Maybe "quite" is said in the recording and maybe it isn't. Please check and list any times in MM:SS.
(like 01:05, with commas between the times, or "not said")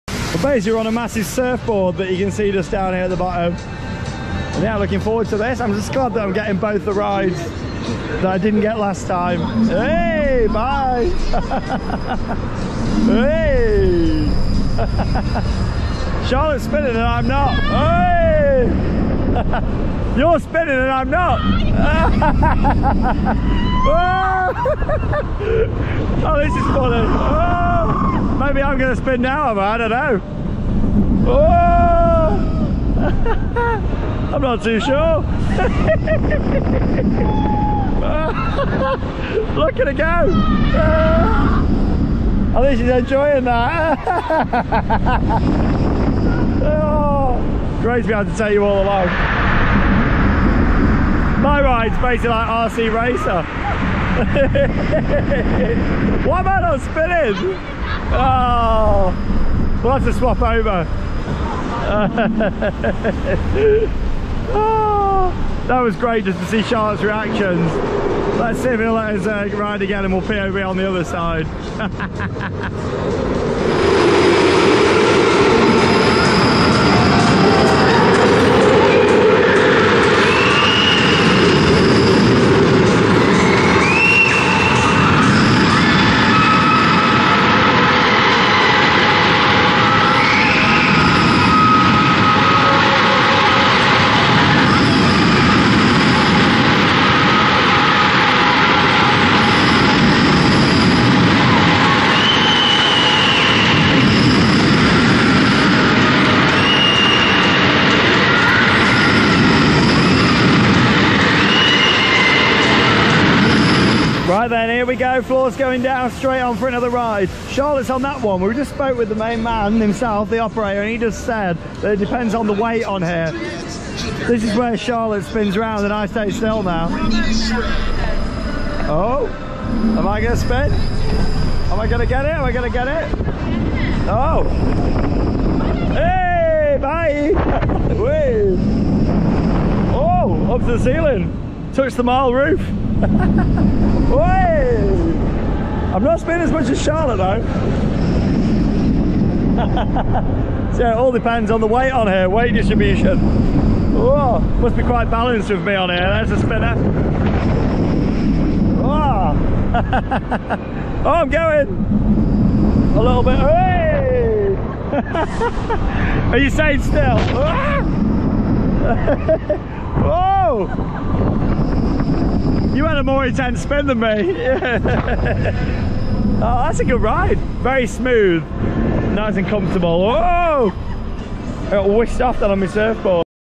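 02:34.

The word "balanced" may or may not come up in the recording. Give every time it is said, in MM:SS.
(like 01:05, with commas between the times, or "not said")
02:35.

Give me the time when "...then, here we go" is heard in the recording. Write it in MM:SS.
01:54.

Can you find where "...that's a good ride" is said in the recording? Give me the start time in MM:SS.
02:56.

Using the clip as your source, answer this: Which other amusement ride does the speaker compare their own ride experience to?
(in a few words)
RC Racer.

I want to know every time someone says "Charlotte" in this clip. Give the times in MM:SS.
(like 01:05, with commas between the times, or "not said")
00:16, 01:06, 01:57, 02:04, 02:26.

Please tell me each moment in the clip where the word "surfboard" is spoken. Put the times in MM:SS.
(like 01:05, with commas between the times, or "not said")
00:01, 03:02.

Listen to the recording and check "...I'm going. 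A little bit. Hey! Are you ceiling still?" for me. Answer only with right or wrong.
wrong.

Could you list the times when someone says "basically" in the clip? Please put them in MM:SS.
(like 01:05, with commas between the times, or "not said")
00:00, 00:51.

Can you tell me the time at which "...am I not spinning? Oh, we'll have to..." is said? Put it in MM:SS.
00:56.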